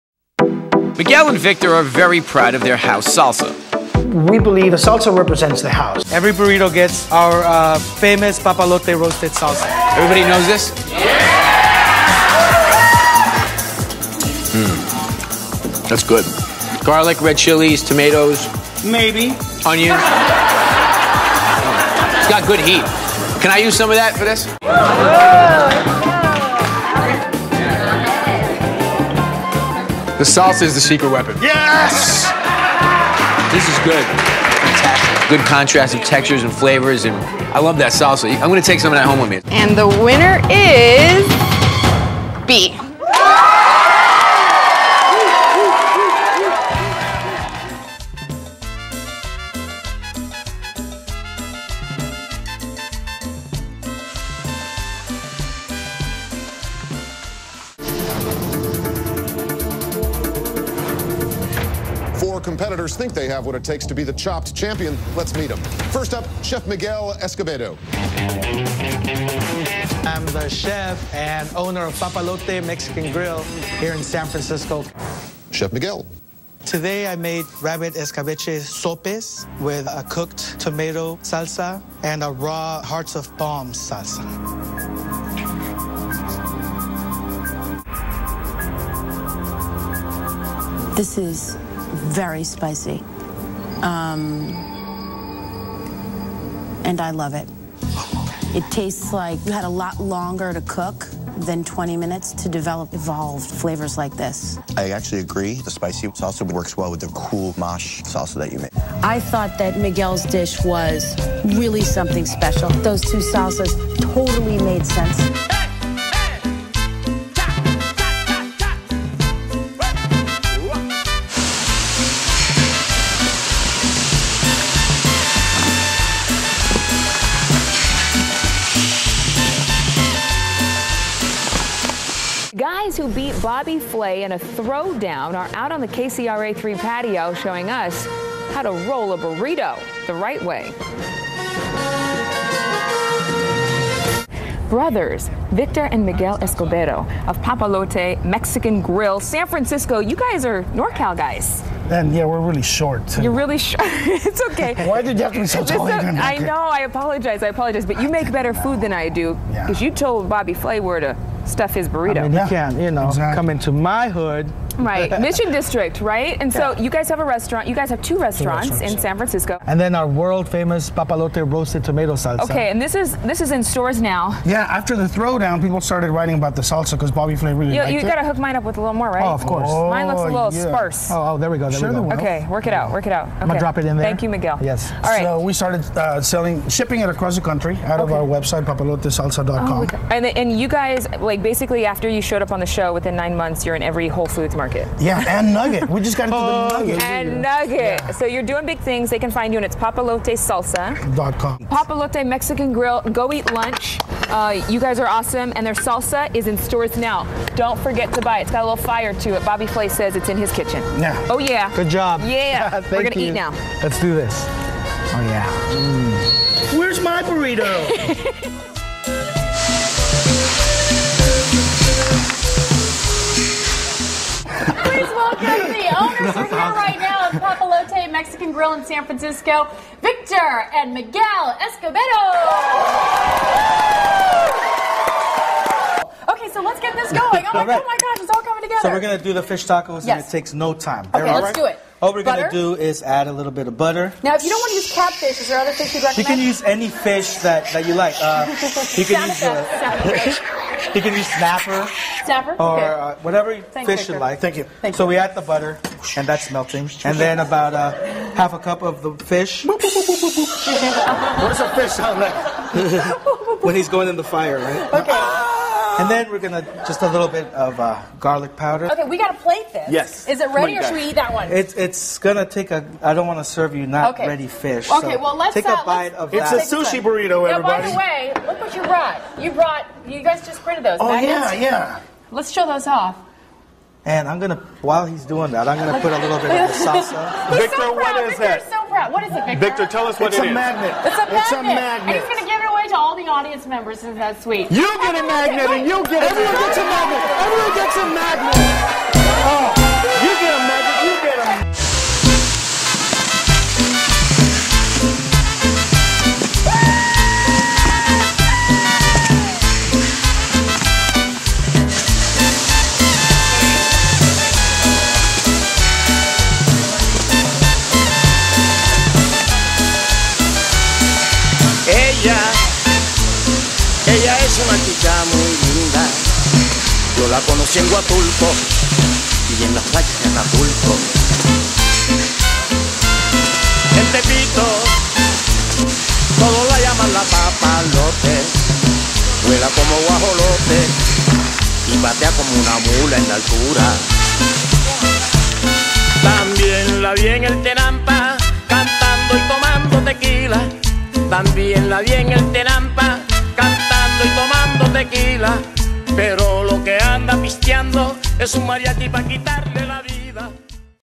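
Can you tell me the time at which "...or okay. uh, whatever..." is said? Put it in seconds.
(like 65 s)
252 s.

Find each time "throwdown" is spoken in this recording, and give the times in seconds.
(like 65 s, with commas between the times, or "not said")
134 s, 175 s.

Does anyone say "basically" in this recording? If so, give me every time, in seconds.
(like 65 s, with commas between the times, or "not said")
191 s.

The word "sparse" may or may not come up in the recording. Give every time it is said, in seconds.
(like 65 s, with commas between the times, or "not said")
180 s.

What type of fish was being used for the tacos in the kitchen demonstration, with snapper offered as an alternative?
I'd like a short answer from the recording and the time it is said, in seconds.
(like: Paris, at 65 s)
Catfish, at 244 s.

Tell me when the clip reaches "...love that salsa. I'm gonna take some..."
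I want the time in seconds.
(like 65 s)
37 s.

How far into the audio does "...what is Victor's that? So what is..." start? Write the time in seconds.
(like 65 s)
287 s.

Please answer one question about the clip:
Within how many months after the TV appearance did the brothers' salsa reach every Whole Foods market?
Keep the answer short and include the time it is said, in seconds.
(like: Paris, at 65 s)
9, at 193 s.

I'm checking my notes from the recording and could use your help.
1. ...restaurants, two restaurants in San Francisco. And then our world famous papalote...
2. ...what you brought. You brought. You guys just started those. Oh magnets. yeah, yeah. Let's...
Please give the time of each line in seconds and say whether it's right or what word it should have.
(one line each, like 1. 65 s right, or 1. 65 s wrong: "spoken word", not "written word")
1. 168 s right
2. 278 s wrong: "printed", not "started".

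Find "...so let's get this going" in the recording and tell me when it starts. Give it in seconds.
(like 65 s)
236 s.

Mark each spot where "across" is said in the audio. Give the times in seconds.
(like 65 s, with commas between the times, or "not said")
187 s.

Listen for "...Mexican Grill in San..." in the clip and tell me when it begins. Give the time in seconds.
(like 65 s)
228 s.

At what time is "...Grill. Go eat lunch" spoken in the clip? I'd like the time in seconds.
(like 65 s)
202 s.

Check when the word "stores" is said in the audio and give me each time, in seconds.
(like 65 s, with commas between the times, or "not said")
173 s, 206 s.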